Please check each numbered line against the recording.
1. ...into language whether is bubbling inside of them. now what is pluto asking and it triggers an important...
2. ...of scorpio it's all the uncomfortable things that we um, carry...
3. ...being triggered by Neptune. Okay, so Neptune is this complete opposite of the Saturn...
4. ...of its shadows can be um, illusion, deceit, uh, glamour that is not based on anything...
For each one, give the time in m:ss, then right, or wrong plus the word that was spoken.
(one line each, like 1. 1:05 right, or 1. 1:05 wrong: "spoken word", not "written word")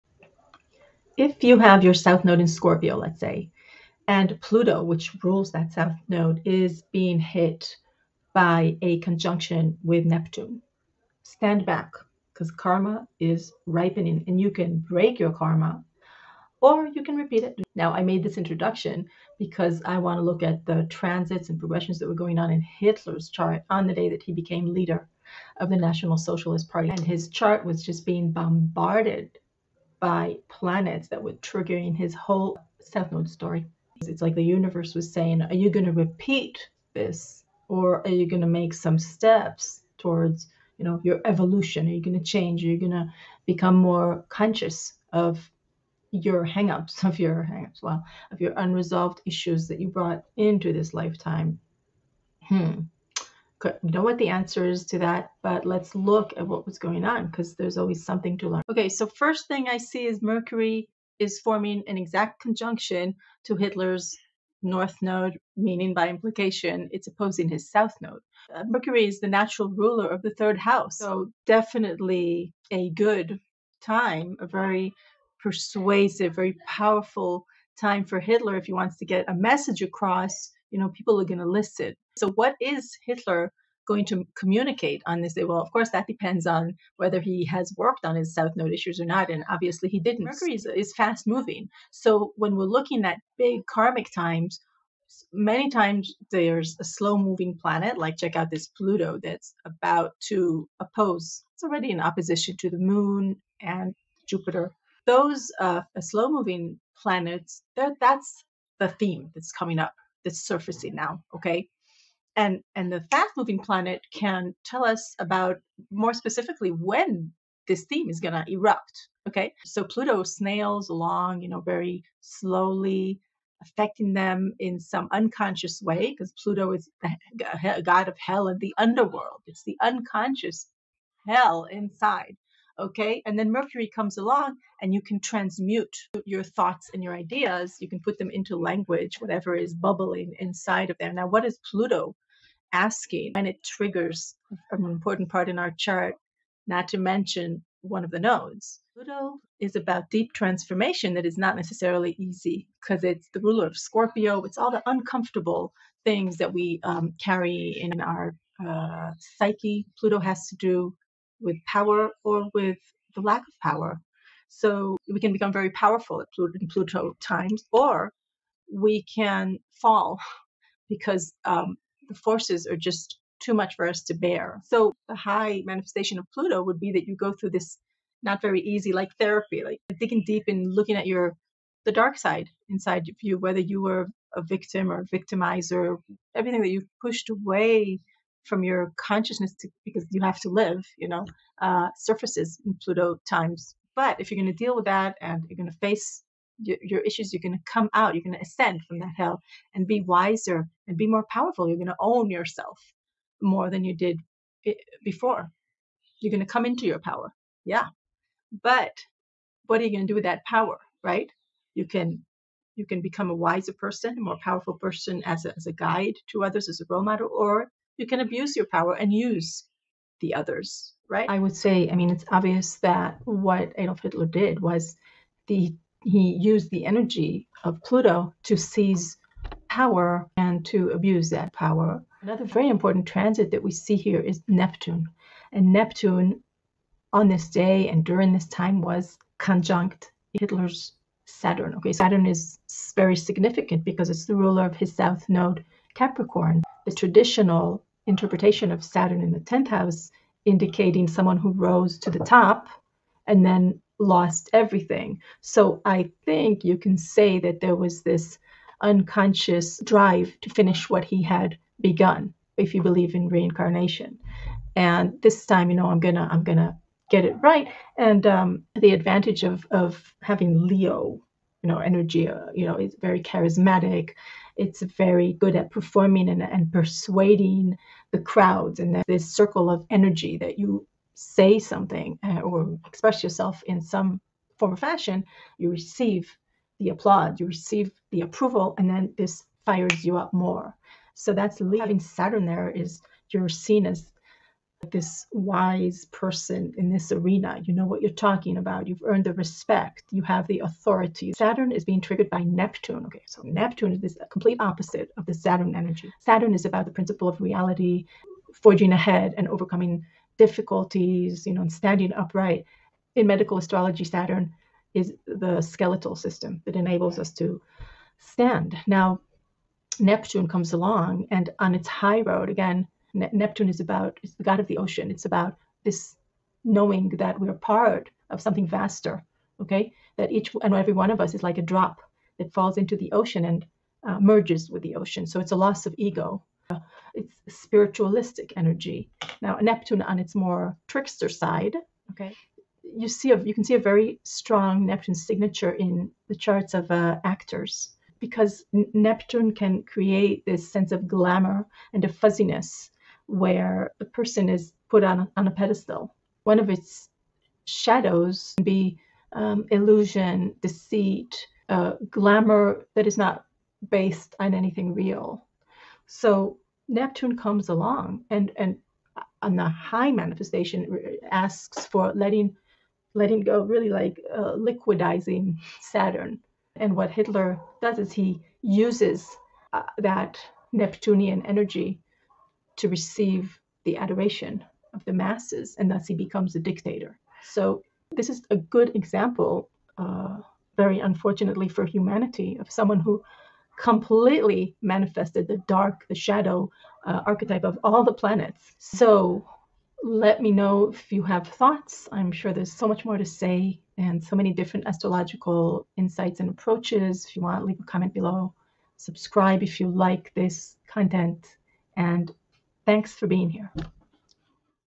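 1. 2:18 wrong: "whatever", not "whether"
2. 2:33 right
3. 5:01 right
4. 5:56 right.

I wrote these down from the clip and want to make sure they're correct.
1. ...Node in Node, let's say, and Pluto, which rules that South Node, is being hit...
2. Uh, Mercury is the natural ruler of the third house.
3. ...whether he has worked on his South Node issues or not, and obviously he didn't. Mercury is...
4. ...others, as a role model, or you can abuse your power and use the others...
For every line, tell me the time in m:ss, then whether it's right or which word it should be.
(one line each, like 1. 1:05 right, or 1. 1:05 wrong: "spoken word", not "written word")
1. 0:02 wrong: "Scorpio", not "Node"
2. 1:08 right
3. 1:26 right
4. 3:36 right.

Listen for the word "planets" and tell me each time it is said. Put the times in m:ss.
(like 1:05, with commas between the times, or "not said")
0:30, 1:37, 1:47, 1:53, 6:38.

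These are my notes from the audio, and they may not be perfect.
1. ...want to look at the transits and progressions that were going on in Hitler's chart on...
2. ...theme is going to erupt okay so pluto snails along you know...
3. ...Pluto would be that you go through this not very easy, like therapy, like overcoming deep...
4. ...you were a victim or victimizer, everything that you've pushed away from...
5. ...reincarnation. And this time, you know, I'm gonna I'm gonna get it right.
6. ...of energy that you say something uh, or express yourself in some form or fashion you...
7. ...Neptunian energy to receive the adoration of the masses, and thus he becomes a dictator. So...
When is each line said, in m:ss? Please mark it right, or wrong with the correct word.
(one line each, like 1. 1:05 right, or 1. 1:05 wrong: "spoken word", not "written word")
1. 0:19 right
2. 1:57 right
3. 2:56 wrong: "digging", not "overcoming"
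4. 3:03 right
5. 4:23 right
6. 4:39 right
7. 6:20 right.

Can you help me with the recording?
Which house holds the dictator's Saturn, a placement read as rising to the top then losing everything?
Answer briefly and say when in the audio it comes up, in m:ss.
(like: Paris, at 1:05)
10th house, at 4:09.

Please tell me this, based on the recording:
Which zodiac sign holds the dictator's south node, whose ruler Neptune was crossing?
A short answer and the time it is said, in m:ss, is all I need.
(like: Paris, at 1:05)
Capricorn, at 4:05.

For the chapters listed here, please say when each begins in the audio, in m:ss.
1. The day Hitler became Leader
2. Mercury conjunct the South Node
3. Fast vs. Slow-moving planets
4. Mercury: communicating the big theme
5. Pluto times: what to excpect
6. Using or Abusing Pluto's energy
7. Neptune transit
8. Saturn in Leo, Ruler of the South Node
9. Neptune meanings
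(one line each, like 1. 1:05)
1. 0:19
2. 0:58
3. 1:30
4. 2:21
5. 2:59
6. 3:33
7. 3:50
8. 4:01
9. 5:03.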